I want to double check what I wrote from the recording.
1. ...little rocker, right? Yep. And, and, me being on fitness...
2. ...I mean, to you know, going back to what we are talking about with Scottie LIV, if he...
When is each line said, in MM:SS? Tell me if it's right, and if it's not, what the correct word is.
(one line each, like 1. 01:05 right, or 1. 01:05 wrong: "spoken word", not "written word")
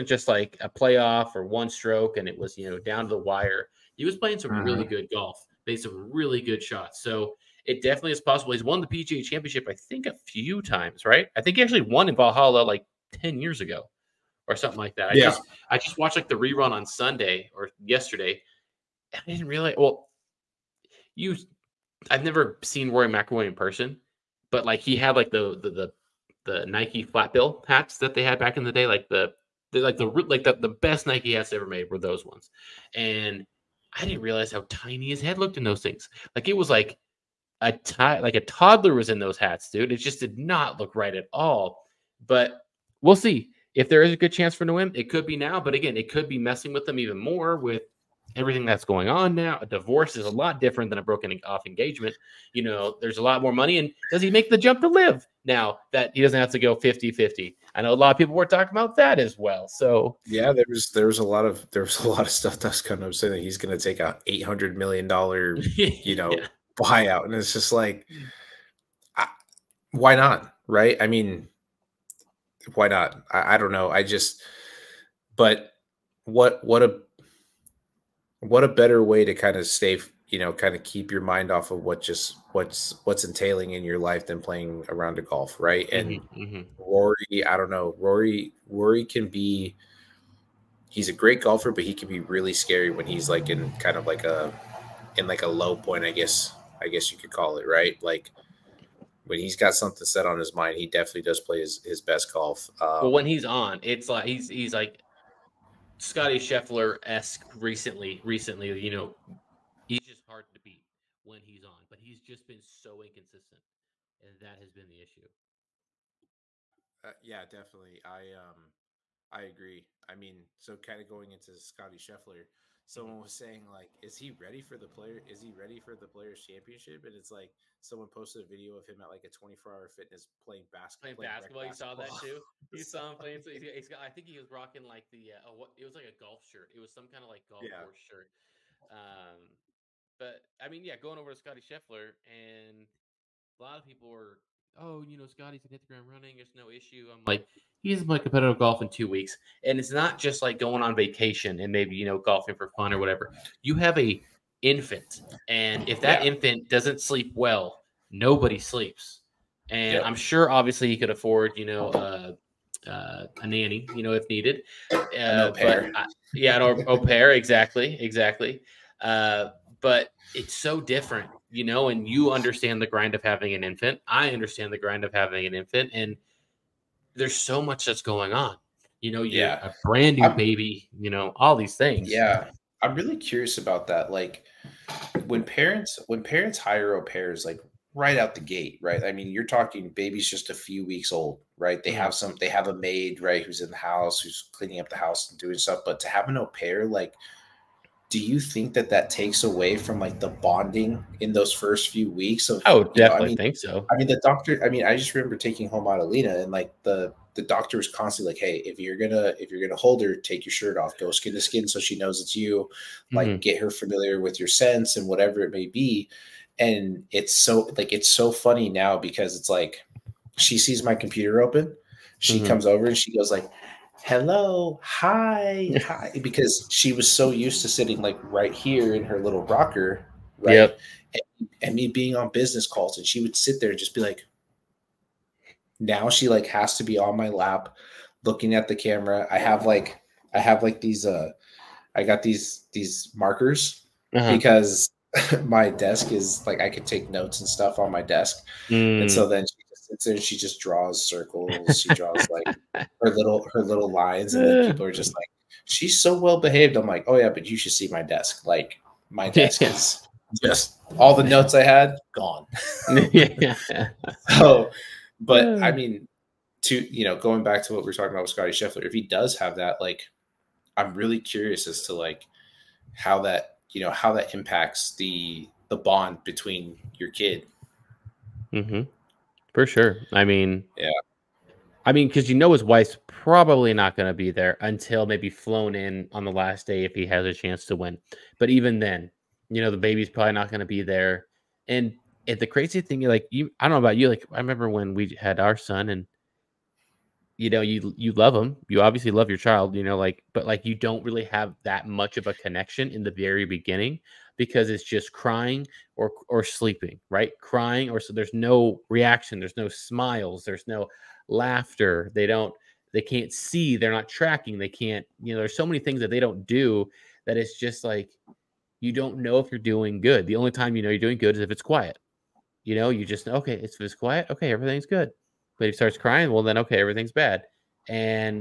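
1. 03:49 wrong: "business", not "fitness"
2. 04:25 wrong: "Scheffler", not "LIV".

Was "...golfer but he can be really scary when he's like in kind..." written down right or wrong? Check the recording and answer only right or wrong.
right.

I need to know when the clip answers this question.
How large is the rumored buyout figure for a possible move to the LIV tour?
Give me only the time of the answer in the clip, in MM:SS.
01:04.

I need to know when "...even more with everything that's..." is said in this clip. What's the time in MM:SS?
00:46.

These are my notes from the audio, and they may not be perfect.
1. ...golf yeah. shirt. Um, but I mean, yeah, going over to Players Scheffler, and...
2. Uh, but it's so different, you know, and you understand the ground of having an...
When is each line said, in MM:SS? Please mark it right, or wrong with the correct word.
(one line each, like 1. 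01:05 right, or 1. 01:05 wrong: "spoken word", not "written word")
1. 02:17 wrong: "Scottie", not "Players"
2. 02:49 wrong: "grind", not "ground".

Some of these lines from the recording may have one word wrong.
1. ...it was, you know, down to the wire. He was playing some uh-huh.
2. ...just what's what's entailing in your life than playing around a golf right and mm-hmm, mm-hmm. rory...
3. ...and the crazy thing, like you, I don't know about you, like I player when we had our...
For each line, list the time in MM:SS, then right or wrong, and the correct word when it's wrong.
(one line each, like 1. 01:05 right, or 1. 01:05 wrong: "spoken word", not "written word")
1. 00:02 right
2. 01:22 right
3. 04:52 wrong: "remember", not "player".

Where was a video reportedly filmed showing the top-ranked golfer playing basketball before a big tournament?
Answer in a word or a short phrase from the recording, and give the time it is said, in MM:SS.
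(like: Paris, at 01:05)
24-Hour Fitness, at 02:09.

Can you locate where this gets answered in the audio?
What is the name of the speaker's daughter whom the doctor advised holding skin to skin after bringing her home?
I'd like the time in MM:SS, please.
03:25.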